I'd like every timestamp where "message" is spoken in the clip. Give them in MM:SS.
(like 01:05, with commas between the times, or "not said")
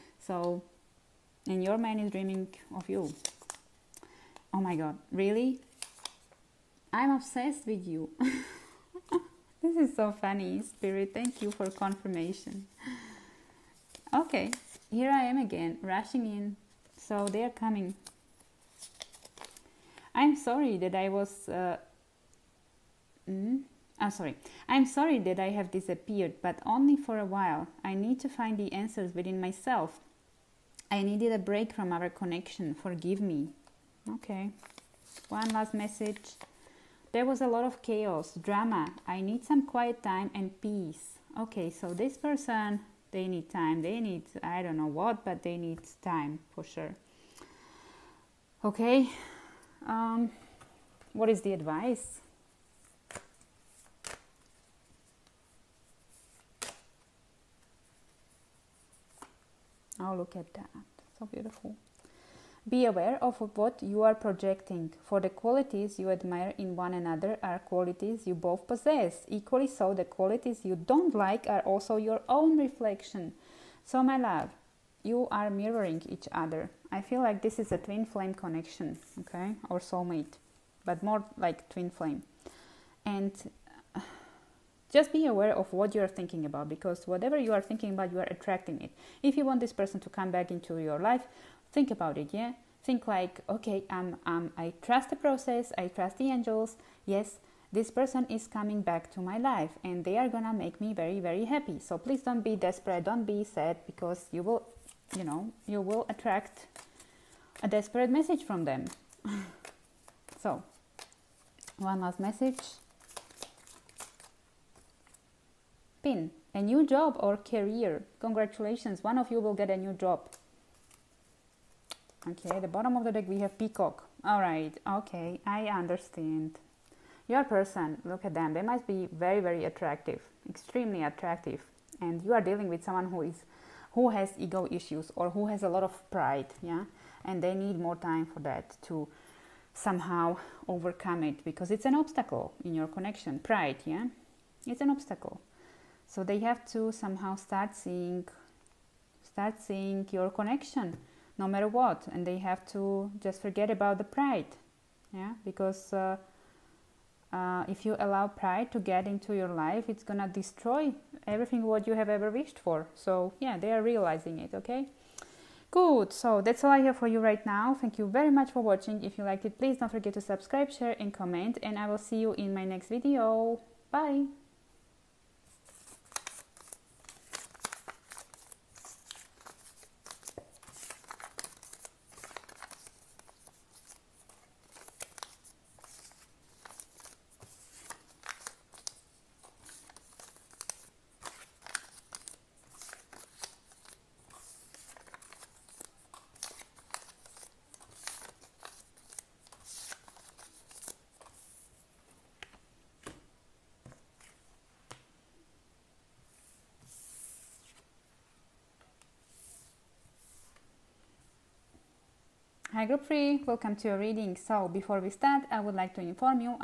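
00:35, 01:48, 01:52.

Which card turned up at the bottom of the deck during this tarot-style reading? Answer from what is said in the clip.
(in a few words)
Peacock.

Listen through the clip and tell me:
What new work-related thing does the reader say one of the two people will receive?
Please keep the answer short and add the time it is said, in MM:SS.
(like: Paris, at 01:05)
A new job or career, at 01:56.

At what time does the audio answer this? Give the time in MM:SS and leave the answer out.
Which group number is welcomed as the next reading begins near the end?
03:32.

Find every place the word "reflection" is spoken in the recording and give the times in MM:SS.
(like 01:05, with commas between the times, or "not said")
01:12.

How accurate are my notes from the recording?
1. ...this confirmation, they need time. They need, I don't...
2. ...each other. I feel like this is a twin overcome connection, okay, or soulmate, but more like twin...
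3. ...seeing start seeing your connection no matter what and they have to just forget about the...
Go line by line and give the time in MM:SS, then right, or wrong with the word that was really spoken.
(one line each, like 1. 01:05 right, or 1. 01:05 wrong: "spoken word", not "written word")
1. 00:41 wrong: "person", not "confirmation"
2. 01:16 wrong: "flame", not "overcome"
3. 02:27 right.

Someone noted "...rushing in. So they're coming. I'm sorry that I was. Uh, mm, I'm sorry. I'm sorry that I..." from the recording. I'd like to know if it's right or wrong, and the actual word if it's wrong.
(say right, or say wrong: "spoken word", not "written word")
right.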